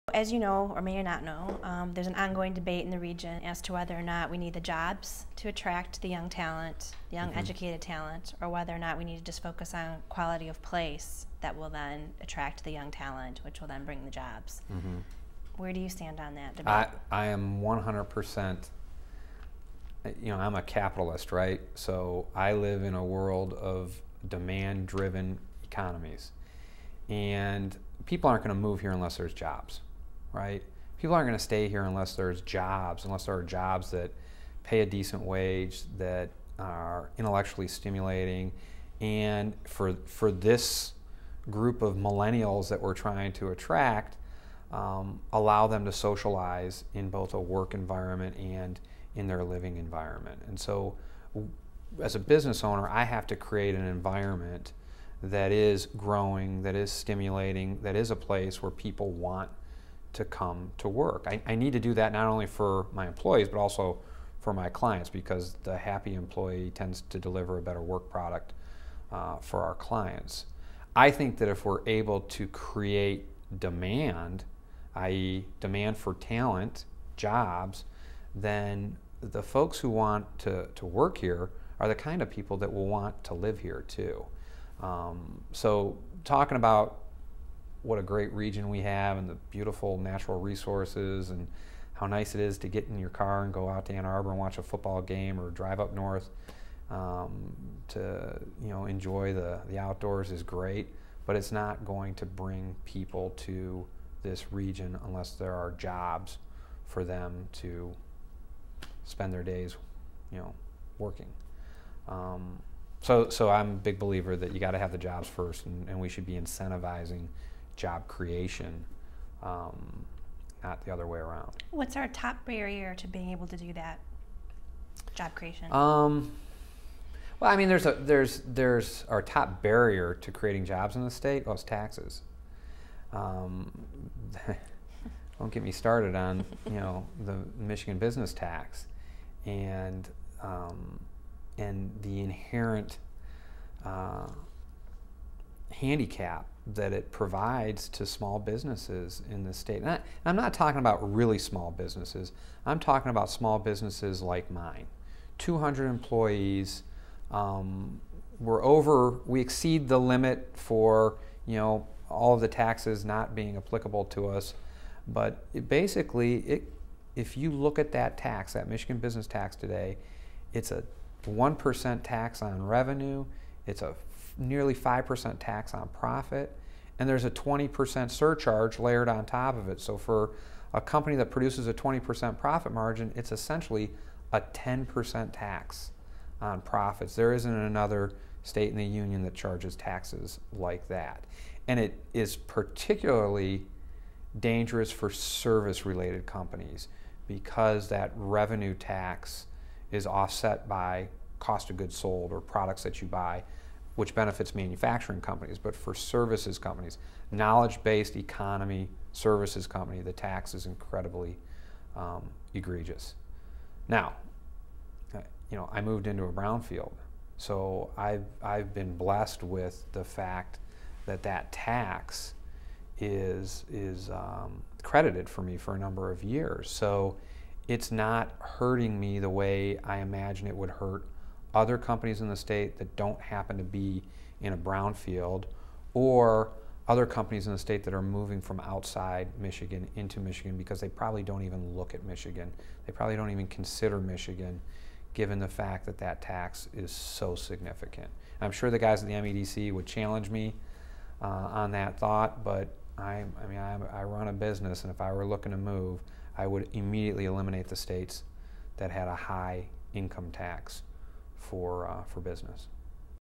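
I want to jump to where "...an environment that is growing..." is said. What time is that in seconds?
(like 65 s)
53 s.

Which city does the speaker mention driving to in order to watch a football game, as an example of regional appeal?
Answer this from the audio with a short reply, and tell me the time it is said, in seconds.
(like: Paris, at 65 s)
Ann Arbor, at 93 s.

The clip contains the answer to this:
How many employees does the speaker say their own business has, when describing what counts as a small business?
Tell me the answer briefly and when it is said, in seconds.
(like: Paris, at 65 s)
200, at 155 s.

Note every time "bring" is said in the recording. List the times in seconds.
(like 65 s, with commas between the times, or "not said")
13 s, 102 s.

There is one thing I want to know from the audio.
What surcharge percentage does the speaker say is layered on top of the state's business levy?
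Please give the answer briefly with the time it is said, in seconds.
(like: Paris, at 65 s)
20%, at 177 s.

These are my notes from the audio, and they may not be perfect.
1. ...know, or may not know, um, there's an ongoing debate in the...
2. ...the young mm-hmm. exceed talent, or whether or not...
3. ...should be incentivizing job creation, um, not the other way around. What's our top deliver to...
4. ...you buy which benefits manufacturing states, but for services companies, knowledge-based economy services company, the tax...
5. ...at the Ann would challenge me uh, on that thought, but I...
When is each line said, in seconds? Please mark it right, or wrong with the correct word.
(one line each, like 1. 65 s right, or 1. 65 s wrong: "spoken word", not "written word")
1. 0 s right
2. 7 s wrong: "educated", not "exceed"
3. 116 s wrong: "barrier", not "deliver"
4. 203 s wrong: "companies", not "states"
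5. 249 s wrong: "MEDC", not "Ann".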